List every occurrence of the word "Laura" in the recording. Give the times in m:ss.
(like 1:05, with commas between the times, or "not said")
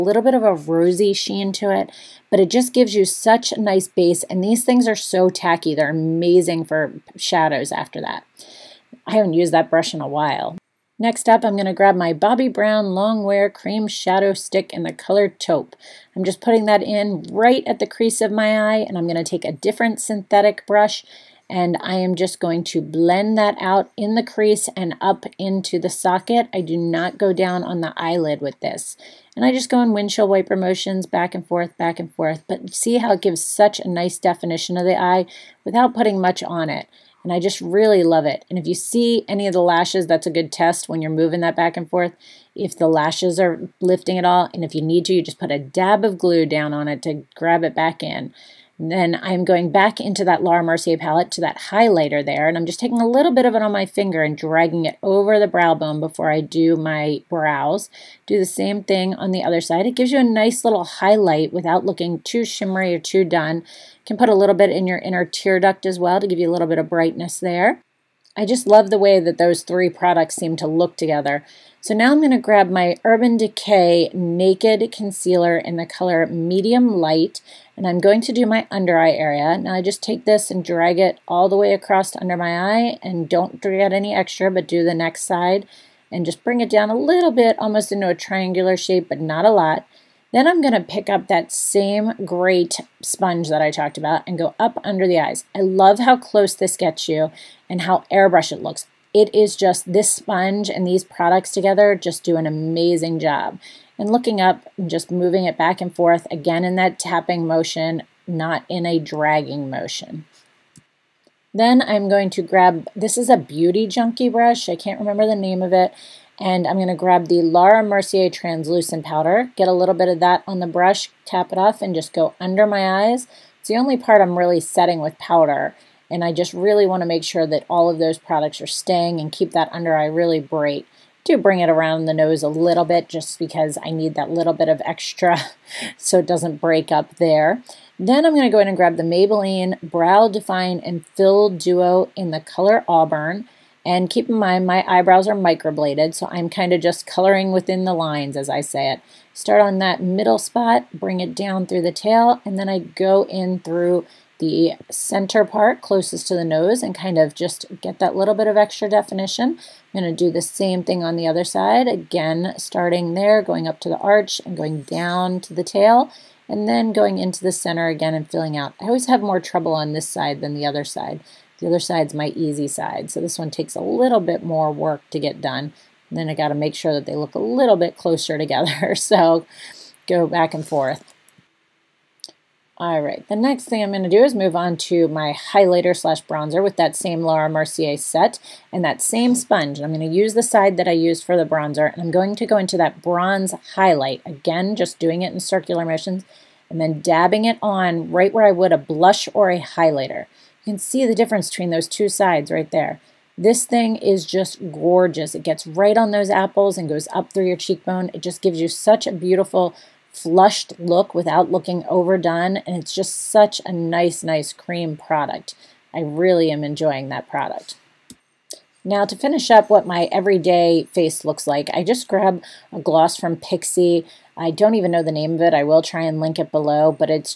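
0:50, 1:57, 3:07.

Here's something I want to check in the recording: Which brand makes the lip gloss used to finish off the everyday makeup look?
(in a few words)
Pixi.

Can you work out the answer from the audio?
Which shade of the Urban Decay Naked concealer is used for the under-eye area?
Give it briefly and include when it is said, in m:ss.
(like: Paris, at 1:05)
Medium Light, at 1:16.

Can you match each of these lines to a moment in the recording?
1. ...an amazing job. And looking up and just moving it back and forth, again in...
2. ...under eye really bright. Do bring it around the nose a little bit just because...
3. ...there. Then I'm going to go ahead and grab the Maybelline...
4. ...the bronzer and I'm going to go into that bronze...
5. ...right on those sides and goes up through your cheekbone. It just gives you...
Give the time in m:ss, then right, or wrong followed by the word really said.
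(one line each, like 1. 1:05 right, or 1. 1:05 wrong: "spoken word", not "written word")
1. 1:42 right
2. 2:09 right
3. 2:17 right
4. 3:11 right
5. 3:25 wrong: "apples", not "sides".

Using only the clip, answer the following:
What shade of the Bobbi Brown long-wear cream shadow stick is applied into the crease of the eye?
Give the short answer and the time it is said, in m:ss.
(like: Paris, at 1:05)
Taupe, at 0:15.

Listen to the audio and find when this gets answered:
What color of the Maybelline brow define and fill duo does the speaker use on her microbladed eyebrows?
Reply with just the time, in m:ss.
2:22.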